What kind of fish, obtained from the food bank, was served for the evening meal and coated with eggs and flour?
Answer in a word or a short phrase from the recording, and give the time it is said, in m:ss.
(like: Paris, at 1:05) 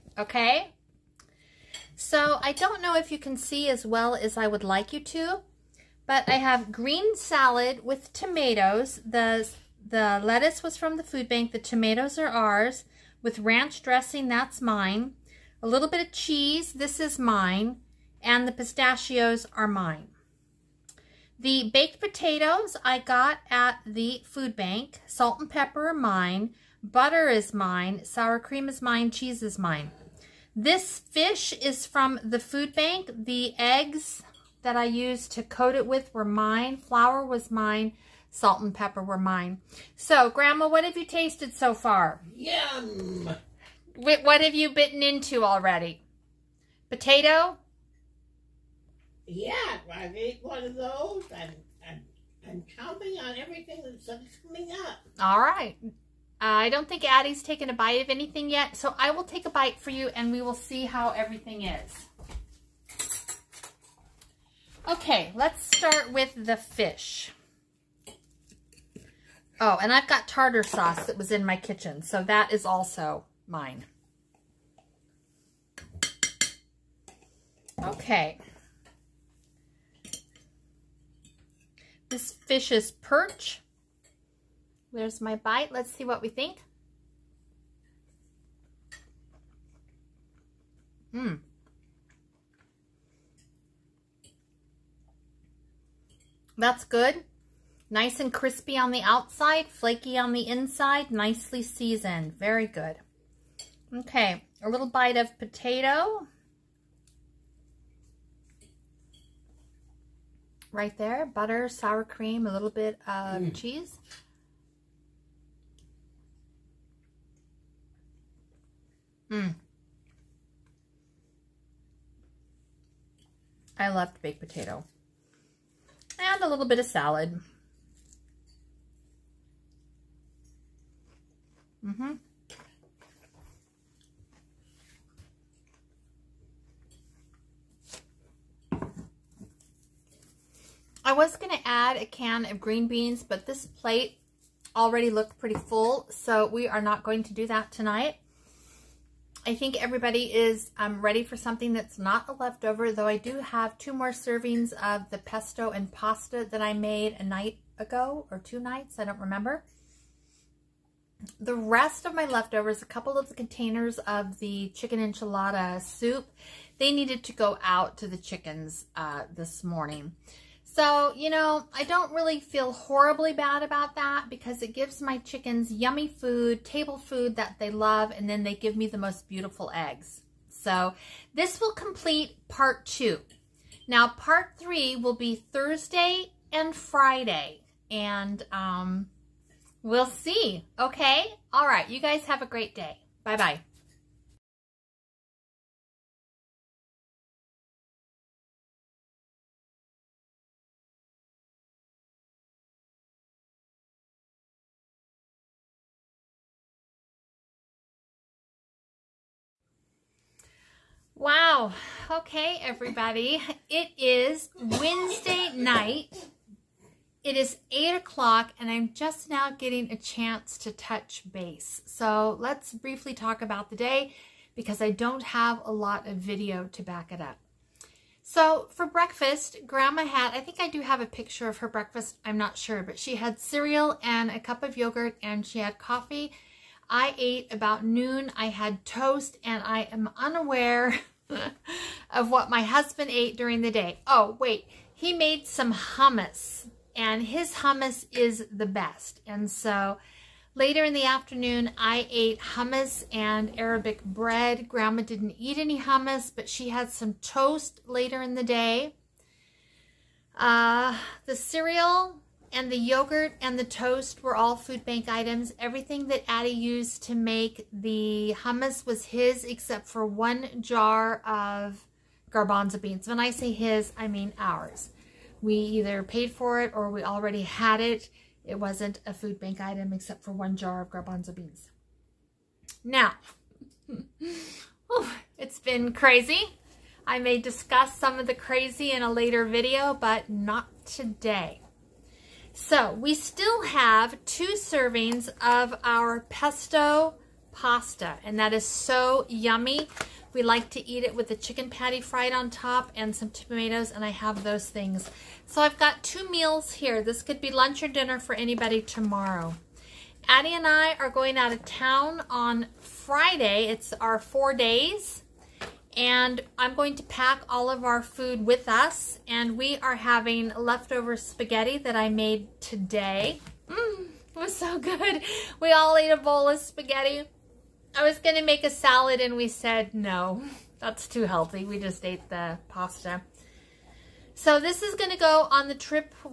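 Perch, at 1:22.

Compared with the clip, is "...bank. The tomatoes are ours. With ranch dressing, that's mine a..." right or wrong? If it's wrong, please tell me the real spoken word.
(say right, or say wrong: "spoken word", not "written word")
right.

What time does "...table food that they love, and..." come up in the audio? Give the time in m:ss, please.
2:56.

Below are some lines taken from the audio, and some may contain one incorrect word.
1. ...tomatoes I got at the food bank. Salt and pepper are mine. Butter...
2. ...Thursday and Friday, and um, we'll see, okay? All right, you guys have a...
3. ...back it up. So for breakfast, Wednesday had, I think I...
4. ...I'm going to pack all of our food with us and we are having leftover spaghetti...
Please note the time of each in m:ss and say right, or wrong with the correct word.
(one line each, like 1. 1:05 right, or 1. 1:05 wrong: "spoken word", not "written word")
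1. 0:21 wrong: "potatoes", not "tomatoes"
2. 3:05 right
3. 3:46 wrong: "Grandma", not "Wednesday"
4. 5:16 right.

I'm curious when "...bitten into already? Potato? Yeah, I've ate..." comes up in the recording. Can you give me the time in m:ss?
0:44.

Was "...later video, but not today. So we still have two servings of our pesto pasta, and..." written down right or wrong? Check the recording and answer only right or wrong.
right.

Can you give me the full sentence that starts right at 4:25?
Everything that Addie used to make the hummus was his except for one jar of garbanzo beans.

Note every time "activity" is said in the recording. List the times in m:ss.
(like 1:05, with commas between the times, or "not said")
not said.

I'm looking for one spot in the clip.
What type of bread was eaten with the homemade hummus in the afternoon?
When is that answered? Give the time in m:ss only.
4:13.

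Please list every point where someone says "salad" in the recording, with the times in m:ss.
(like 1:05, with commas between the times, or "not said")
0:07, 2:06, 5:28.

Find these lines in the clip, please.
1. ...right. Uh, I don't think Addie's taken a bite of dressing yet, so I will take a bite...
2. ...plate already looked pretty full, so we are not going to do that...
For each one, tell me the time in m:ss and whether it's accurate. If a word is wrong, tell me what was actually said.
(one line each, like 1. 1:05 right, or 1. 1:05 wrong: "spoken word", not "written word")
1. 0:55 wrong: "anything", not "dressing"
2. 2:23 right.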